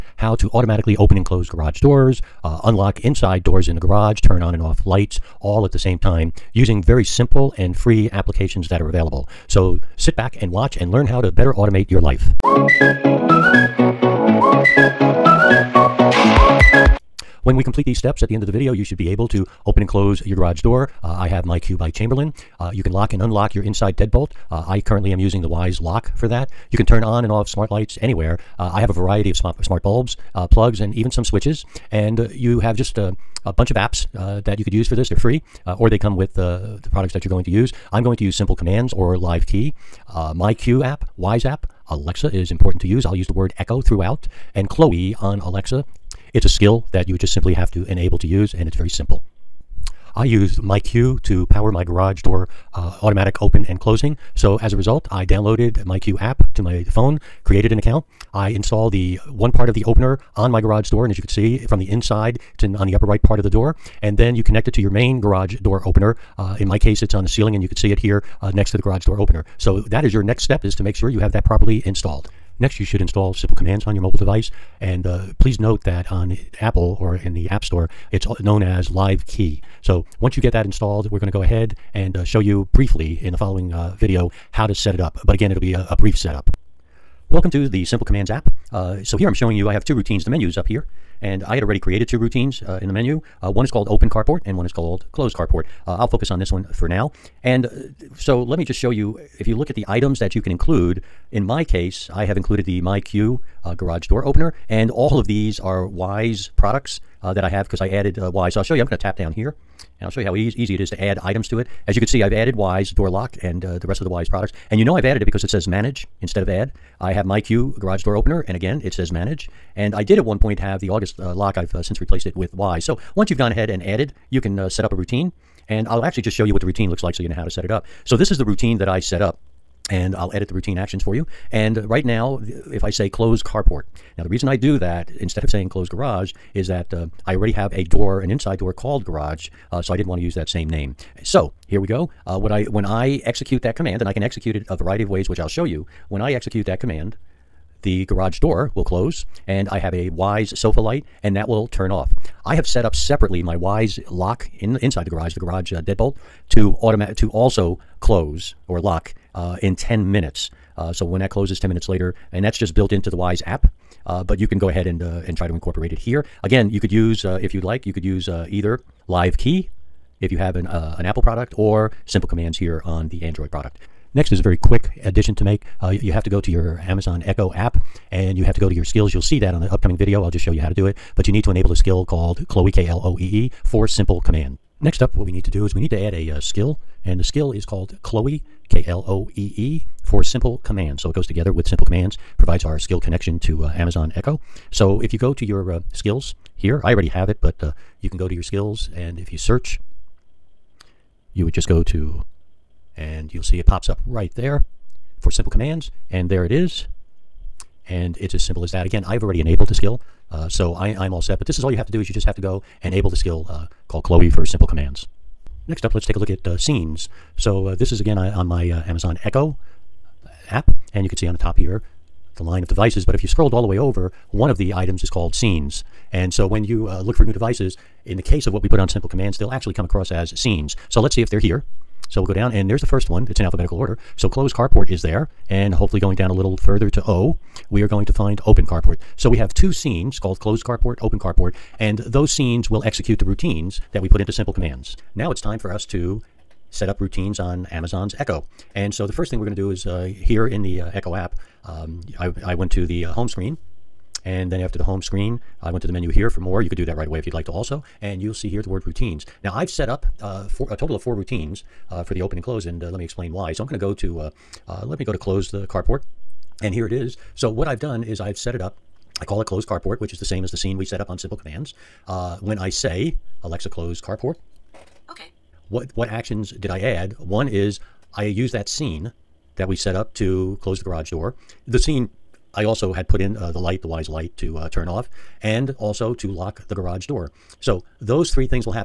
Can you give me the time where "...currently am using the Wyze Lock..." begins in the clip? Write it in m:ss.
0:24.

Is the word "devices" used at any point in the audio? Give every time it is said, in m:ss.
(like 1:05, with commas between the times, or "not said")
1:14, 3:42, 3:47.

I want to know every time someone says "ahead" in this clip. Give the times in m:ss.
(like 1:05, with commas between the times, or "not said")
1:21, 2:03, 2:44.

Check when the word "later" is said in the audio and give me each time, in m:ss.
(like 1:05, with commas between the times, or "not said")
2:41.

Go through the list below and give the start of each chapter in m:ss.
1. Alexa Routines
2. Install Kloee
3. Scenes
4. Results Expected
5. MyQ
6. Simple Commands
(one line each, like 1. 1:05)
1. 4:08
2. 2:53
3. 3:35
4. 0:16
5. 0:49
6. 1:12.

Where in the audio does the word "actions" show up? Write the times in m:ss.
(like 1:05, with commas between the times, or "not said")
2:10, 4:36.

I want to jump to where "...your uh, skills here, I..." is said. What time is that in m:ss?
3:15.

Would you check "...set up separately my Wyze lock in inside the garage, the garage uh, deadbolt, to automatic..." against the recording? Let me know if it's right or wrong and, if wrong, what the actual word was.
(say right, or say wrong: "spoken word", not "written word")
right.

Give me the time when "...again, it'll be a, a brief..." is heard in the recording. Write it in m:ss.
1:25.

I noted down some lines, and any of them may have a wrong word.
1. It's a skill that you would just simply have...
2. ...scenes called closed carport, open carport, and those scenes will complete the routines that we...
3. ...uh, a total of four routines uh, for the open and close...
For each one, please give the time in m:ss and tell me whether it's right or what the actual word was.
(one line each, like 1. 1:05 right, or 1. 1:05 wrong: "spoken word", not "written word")
1. 0:46 right
2. 3:59 wrong: "execute", not "complete"
3. 4:20 right.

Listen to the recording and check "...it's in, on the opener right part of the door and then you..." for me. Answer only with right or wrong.
wrong.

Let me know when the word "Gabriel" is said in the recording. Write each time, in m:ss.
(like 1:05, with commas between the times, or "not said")
not said.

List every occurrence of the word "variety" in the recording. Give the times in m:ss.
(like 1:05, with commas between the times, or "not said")
0:28, 2:24.